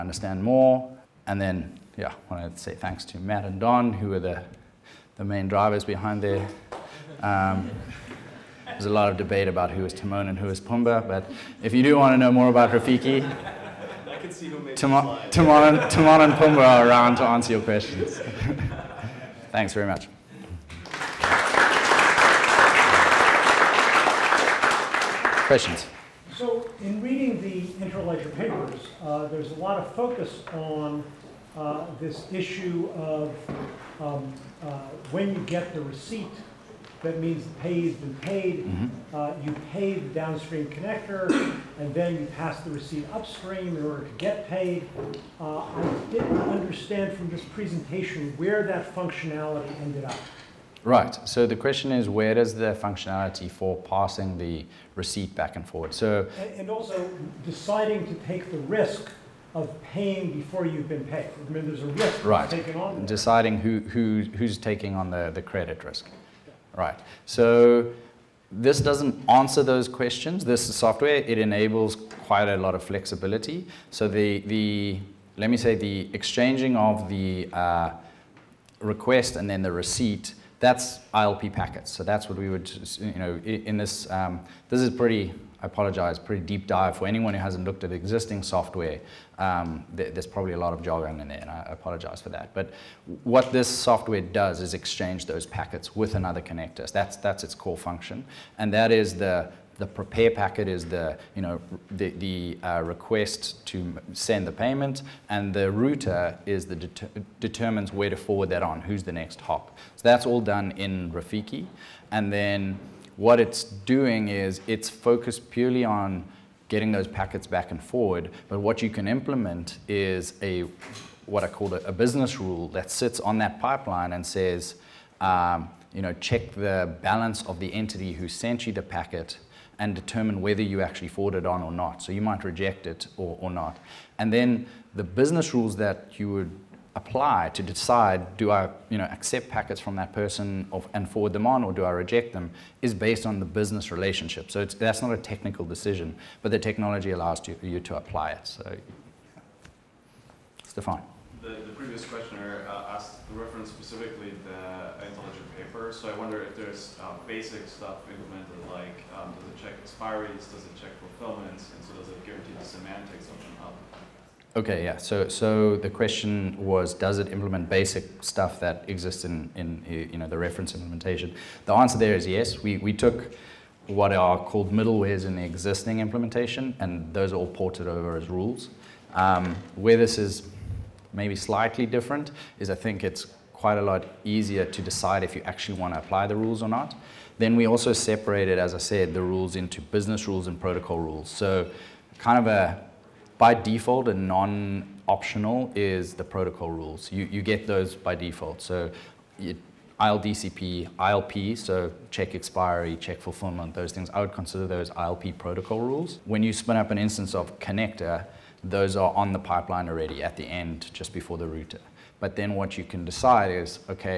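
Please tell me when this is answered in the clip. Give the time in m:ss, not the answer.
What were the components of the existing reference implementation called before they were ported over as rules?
2:54.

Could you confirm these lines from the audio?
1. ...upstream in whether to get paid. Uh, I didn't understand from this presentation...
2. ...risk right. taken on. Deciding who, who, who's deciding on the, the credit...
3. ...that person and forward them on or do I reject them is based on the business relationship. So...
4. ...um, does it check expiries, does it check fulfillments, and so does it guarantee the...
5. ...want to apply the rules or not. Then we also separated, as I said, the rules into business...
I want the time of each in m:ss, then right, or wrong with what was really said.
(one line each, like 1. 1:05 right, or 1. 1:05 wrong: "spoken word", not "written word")
1. 0:43 wrong: "order", not "whether"
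2. 1:02 wrong: "taking", not "deciding"
3. 2:19 right
4. 2:39 right
5. 3:05 right.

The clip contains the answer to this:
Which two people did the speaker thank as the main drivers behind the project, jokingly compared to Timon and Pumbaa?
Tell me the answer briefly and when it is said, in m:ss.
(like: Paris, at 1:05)
Matt and Don, at 0:03.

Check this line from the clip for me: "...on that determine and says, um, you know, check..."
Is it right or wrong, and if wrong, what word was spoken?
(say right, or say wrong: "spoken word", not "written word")
wrong: "pipeline", not "determine".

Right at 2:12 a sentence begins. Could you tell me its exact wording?
So you might reject it or, or not.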